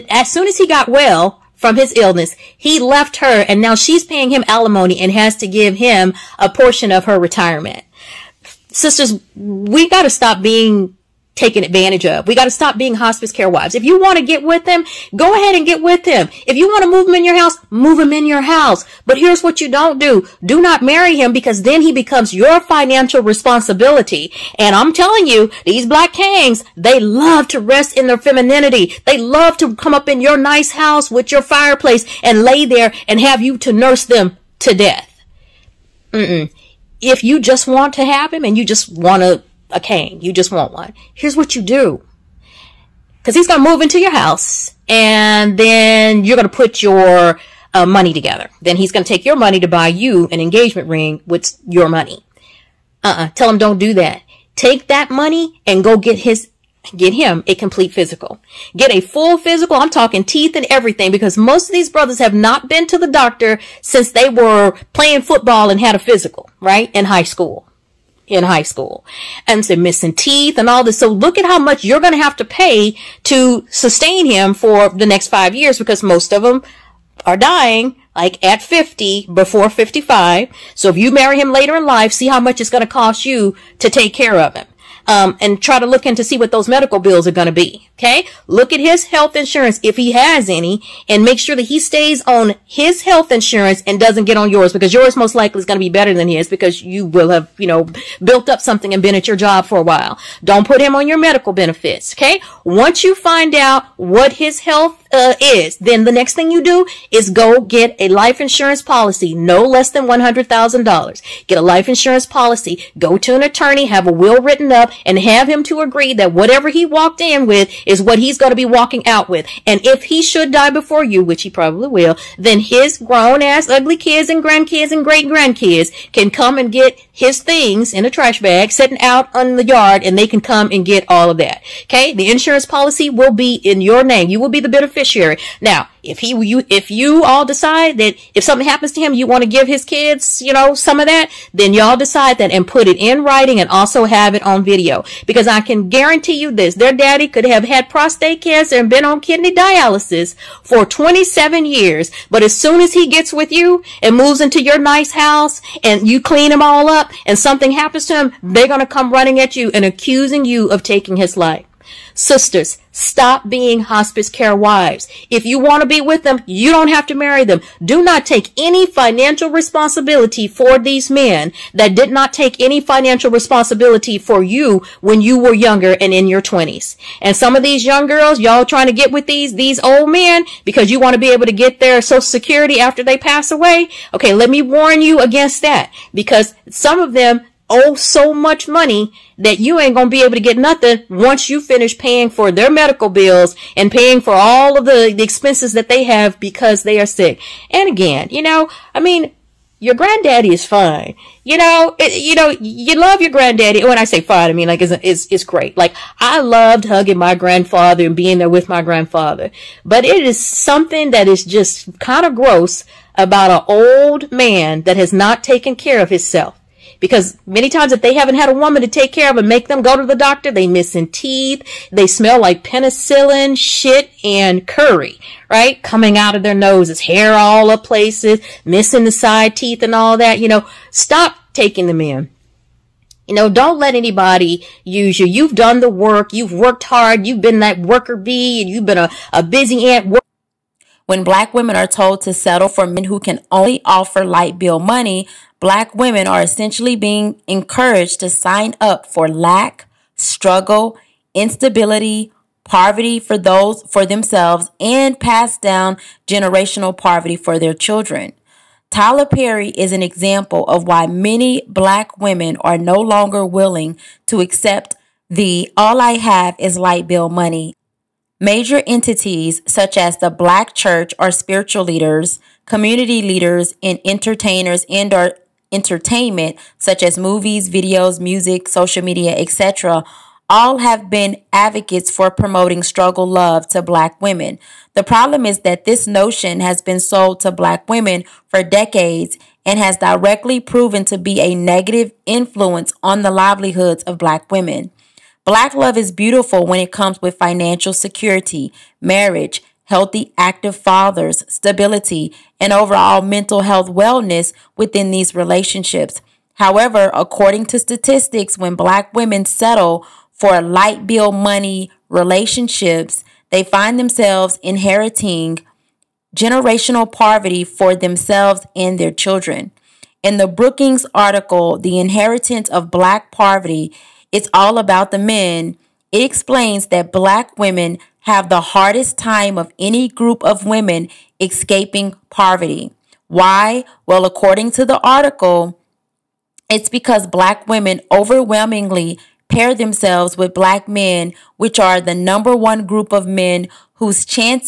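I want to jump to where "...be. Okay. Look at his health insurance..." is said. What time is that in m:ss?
1:27.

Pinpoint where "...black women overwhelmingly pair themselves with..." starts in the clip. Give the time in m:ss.
5:37.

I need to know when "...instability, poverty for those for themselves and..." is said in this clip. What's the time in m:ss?
4:11.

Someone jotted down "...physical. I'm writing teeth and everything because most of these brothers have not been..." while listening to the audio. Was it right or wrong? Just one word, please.
wrong.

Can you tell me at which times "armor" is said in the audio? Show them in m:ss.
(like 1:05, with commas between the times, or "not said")
not said.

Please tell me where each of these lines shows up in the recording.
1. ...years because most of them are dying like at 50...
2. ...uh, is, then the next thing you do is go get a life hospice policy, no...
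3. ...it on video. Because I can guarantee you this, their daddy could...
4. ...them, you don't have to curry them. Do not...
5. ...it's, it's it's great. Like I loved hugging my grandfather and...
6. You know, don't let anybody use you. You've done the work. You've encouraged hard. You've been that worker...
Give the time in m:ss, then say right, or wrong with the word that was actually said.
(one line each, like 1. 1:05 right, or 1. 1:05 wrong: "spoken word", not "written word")
1. 1:15 right
2. 1:45 wrong: "insurance", not "hospice"
3. 2:24 right
4. 2:46 wrong: "marry", not "curry"
5. 3:24 right
6. 3:53 wrong: "worked", not "encouraged".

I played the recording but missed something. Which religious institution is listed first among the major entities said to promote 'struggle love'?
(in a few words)
The Black Church.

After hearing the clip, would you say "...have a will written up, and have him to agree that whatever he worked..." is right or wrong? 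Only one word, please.
wrong.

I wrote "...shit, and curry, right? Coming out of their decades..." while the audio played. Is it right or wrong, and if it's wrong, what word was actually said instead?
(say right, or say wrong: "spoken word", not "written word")
wrong: "noses", not "decades".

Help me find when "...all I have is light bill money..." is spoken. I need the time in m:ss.
4:25.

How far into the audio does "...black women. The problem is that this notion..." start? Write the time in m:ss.
4:43.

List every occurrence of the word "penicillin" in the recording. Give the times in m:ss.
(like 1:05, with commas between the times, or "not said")
3:42.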